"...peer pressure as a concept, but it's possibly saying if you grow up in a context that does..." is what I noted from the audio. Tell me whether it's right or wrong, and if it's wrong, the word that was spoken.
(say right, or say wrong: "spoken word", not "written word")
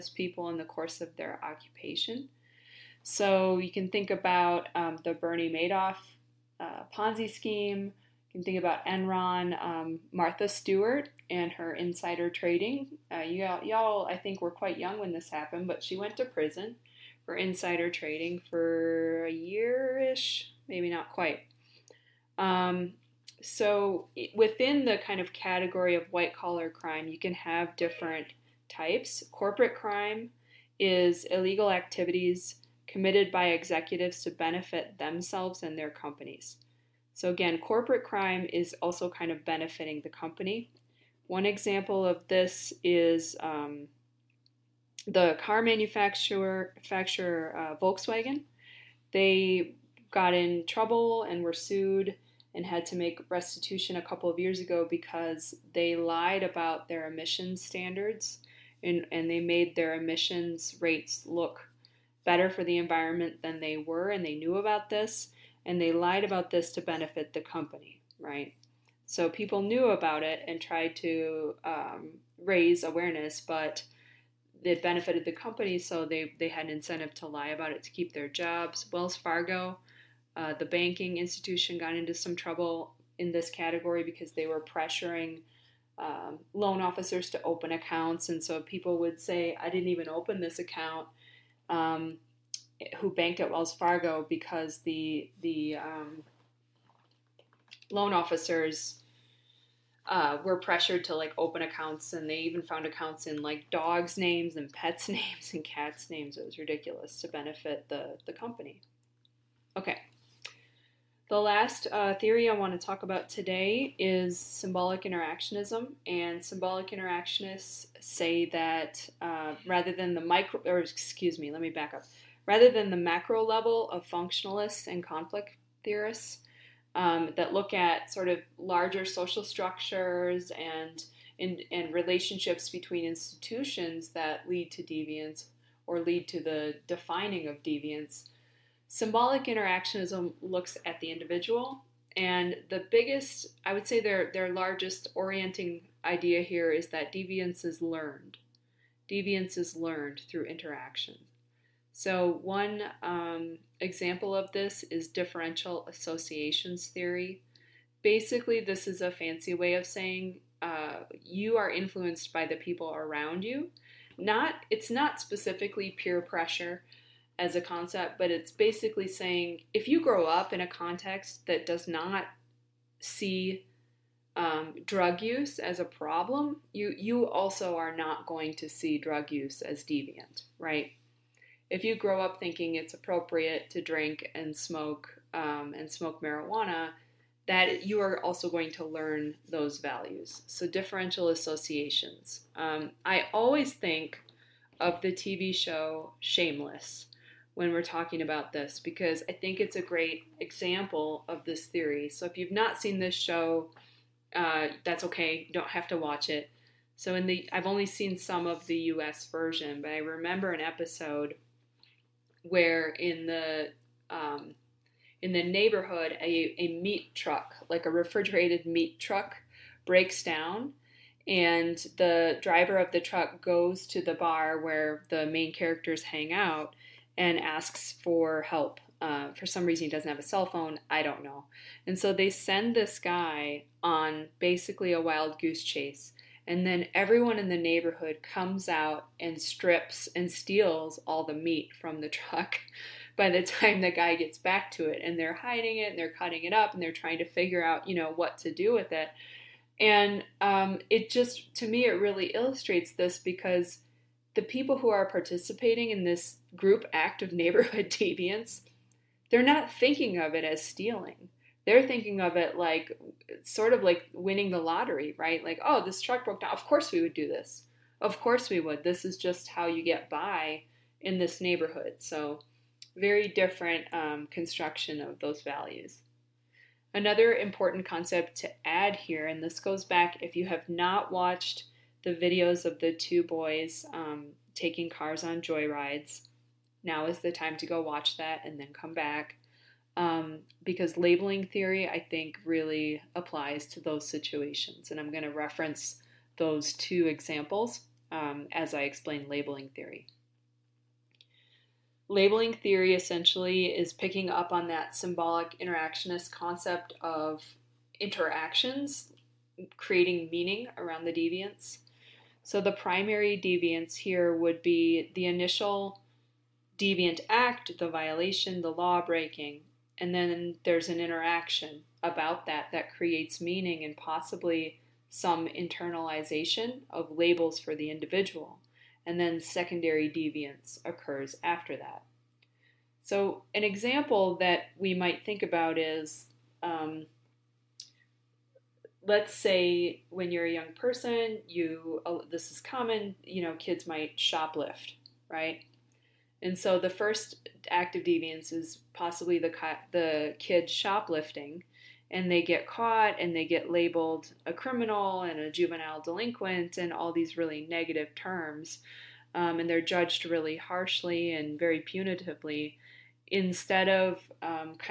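wrong: "basically", not "possibly".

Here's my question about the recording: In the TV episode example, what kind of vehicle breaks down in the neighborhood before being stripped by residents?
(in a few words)
refrigerated meat truck.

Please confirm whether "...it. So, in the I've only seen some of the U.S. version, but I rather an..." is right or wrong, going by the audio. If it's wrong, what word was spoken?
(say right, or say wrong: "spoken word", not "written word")
wrong: "remember", not "rather".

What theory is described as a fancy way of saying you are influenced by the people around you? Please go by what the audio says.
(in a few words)
differential associations theory.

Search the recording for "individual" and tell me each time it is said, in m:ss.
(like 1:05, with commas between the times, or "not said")
2:21, 5:27.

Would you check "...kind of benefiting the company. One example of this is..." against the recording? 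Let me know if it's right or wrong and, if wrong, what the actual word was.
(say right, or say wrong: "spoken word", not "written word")
right.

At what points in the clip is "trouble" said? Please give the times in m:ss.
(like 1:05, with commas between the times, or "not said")
0:50, 1:22.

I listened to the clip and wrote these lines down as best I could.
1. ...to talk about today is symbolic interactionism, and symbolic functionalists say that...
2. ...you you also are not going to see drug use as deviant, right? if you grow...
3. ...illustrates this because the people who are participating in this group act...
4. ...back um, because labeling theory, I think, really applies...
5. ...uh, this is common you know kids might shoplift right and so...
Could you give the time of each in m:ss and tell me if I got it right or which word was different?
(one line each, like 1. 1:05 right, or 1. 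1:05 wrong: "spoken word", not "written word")
1. 1:52 wrong: "interactionists", not "functionalists"
2. 2:56 right
3. 4:12 right
4. 4:48 right
5. 5:42 right.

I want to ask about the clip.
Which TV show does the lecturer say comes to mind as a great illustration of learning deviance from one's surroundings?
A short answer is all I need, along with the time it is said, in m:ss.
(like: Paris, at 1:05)
Shameless, at 3:16.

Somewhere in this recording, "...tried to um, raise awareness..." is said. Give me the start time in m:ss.
1:10.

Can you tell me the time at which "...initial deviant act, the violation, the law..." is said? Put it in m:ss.
5:15.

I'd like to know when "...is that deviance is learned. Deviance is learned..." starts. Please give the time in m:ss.
2:26.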